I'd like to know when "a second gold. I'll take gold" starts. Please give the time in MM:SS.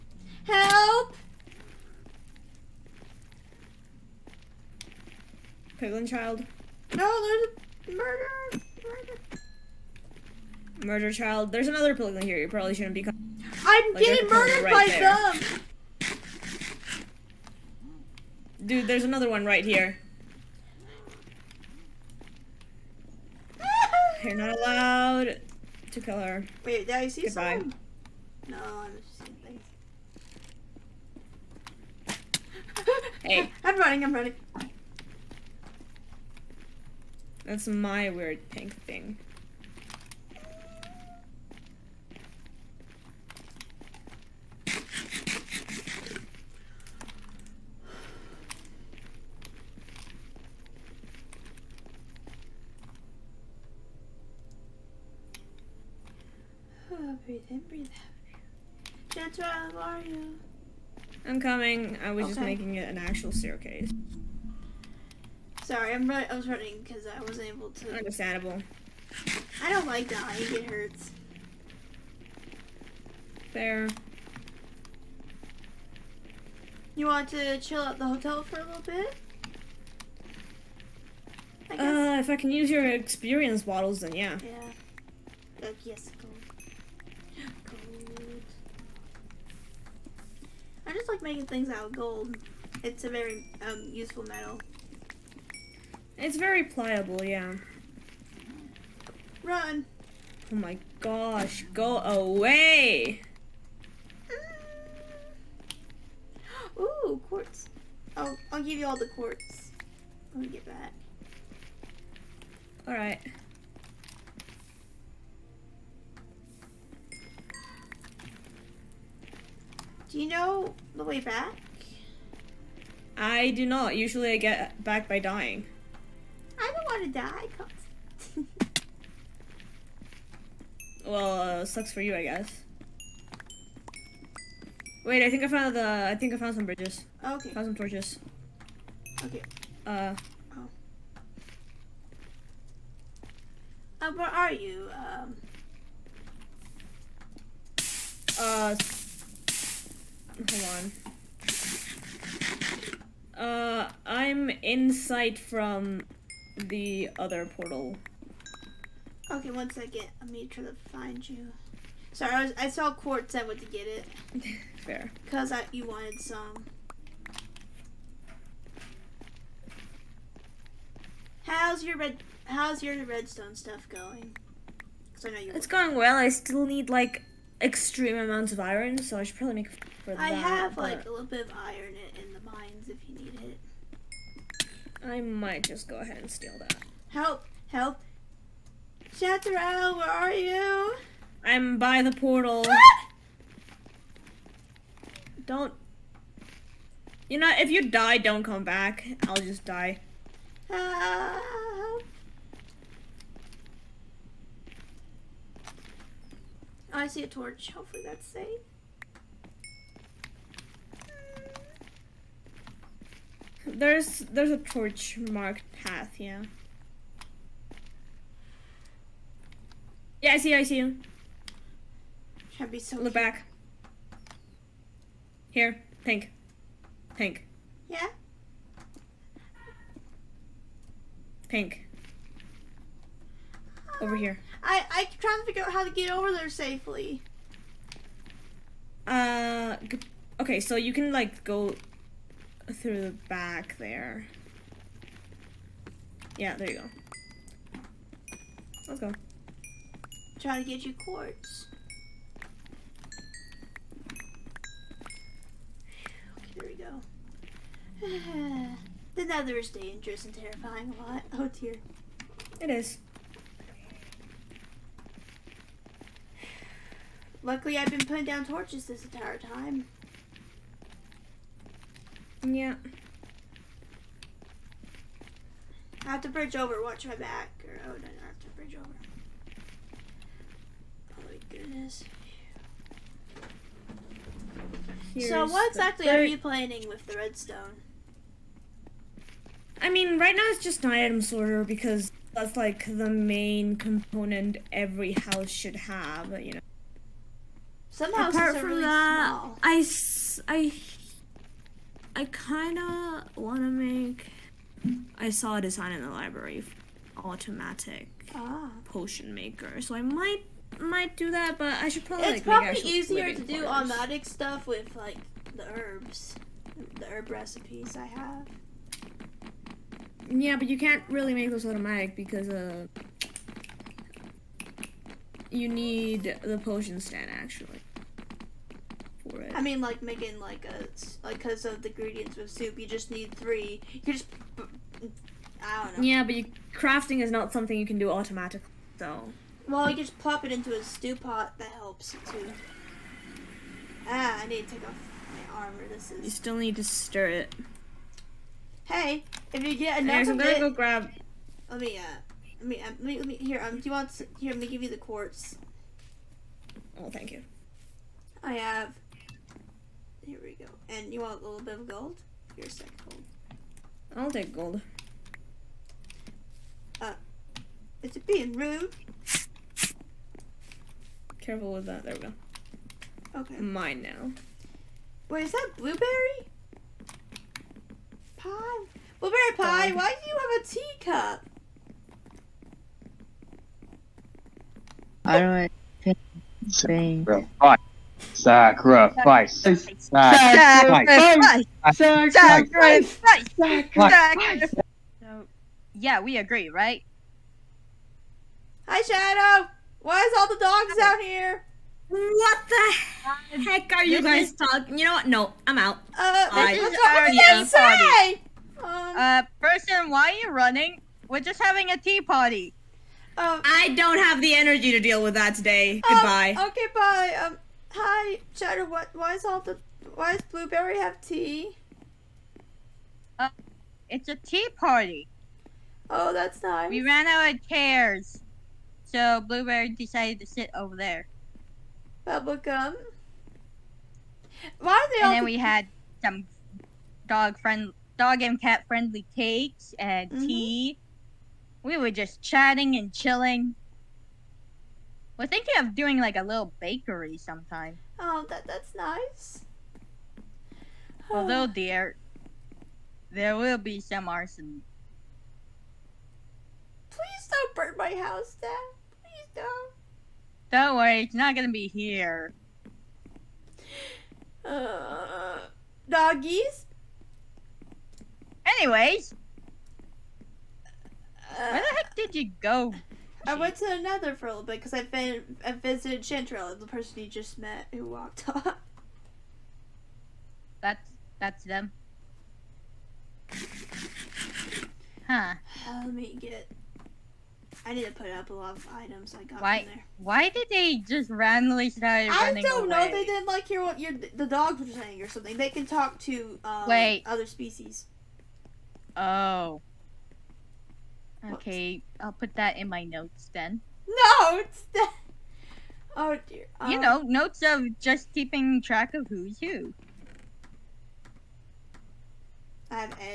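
06:02.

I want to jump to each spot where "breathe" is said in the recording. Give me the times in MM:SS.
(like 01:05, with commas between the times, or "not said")
00:44, 00:57.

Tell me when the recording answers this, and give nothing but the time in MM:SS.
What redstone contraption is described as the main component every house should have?
04:50.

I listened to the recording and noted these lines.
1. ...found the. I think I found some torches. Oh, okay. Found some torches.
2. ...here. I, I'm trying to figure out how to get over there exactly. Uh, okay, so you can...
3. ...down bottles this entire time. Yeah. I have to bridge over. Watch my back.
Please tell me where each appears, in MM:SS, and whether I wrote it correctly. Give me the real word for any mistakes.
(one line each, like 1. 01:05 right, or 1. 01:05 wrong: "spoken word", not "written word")
1. 02:15 wrong: "bridges", not "torches"
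2. 03:54 wrong: "safely", not "exactly"
3. 04:28 wrong: "torches", not "bottles".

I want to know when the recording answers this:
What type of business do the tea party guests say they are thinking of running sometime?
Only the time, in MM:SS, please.
07:26.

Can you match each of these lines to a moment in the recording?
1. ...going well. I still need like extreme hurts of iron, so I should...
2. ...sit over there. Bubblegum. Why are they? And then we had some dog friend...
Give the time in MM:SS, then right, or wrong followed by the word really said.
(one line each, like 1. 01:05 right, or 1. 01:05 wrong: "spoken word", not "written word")
1. 02:55 wrong: "amounts", not "hurts"
2. 07:10 right.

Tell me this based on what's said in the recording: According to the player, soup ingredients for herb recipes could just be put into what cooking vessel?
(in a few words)
stew pot.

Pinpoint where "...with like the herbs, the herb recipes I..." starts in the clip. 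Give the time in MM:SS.
05:14.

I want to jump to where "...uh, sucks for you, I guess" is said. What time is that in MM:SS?
02:11.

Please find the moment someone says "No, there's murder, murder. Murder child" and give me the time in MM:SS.
00:06.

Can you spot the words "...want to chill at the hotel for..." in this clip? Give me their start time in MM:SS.
01:17.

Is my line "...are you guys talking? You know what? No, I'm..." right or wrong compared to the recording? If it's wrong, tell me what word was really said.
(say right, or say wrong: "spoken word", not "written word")
right.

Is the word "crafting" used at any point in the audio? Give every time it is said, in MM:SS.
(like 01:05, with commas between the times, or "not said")
05:36.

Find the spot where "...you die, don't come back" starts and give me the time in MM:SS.
03:17.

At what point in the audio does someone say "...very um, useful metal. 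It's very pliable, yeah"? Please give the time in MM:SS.
01:33.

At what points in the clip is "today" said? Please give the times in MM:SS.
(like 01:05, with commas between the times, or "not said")
06:55.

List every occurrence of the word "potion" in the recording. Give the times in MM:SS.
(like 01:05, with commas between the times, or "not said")
05:08, 05:26.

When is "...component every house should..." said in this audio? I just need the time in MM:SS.
04:53.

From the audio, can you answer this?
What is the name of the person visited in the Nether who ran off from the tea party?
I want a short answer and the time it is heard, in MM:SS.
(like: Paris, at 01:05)
Chantrell, at 07:56.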